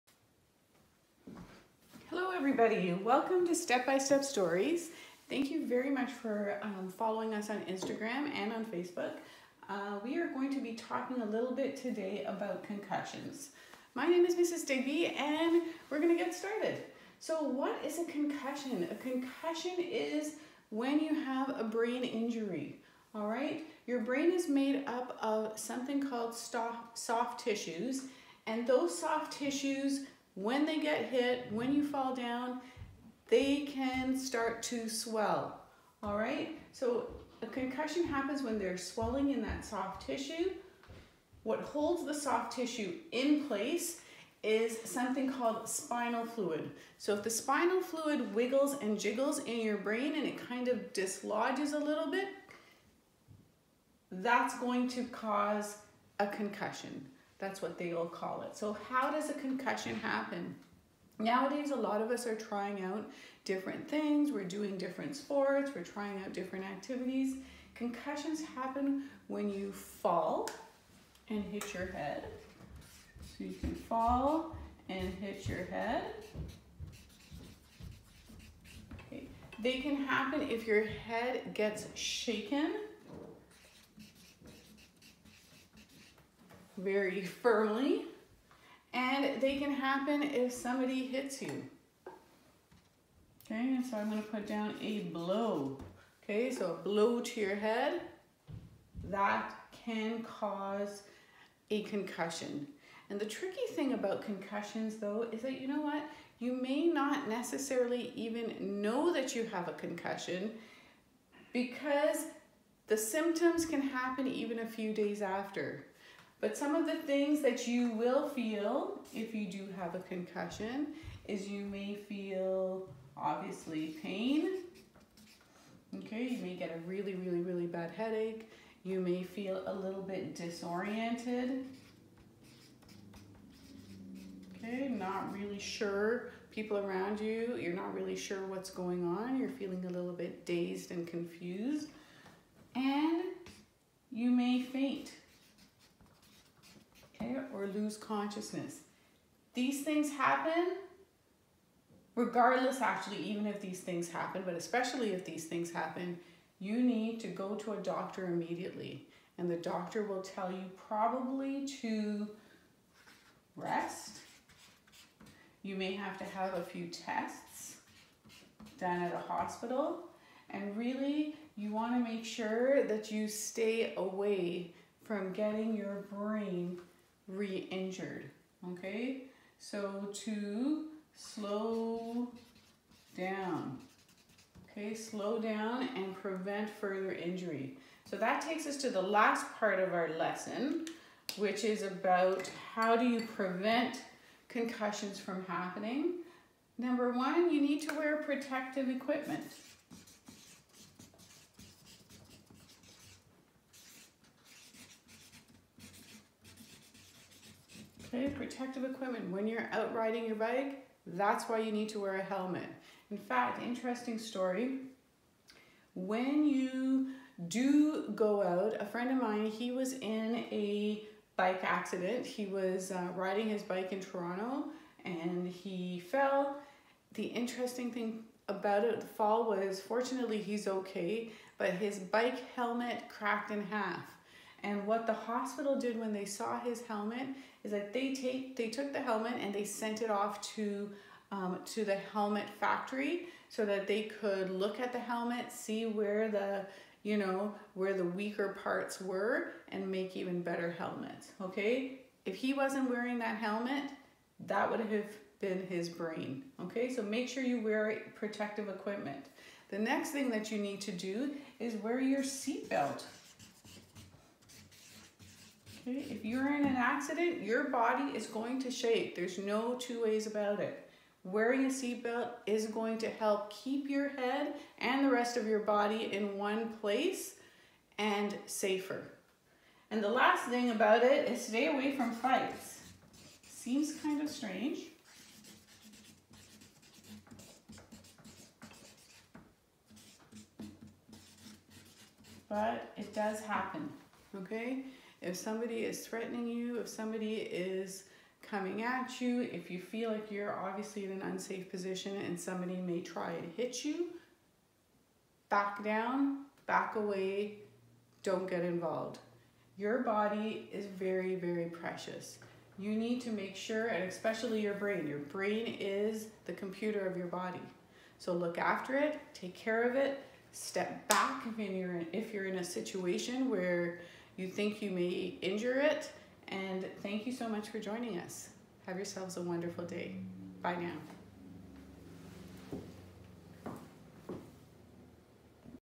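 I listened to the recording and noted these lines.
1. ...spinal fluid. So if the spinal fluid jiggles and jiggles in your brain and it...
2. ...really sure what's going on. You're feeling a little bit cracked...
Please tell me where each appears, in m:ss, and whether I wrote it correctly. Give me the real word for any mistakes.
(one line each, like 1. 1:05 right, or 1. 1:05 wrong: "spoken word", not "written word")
1. 0:45 wrong: "wiggles", not "jiggles"
2. 2:17 wrong: "dazed", not "cracked".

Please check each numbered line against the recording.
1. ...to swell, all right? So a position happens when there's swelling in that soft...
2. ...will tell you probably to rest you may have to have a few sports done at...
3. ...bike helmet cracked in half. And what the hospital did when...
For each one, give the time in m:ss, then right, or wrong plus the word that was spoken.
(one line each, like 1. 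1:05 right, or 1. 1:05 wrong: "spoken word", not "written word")
1. 0:34 wrong: "concussion", not "position"
2. 2:40 wrong: "tests", not "sports"
3. 3:51 right.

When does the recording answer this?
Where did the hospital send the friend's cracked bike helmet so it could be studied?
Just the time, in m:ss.
4:01.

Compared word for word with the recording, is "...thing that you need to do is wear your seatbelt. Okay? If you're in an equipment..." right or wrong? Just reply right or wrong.
wrong.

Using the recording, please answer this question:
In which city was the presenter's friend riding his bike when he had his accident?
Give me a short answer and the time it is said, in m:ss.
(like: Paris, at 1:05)
Toronto, at 3:44.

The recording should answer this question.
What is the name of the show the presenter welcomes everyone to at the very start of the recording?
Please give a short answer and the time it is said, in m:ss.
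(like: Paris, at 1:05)
Step by Step Stories, at 0:03.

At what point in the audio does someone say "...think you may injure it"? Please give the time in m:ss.
5:24.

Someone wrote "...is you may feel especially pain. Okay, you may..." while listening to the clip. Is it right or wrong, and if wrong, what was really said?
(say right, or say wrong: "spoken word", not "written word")
wrong: "obviously", not "especially".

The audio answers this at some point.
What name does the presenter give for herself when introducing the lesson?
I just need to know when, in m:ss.
0:14.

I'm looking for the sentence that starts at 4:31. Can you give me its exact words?
Wearing a seatbelt is going to help keep your head and the rest of your body in one place and safer.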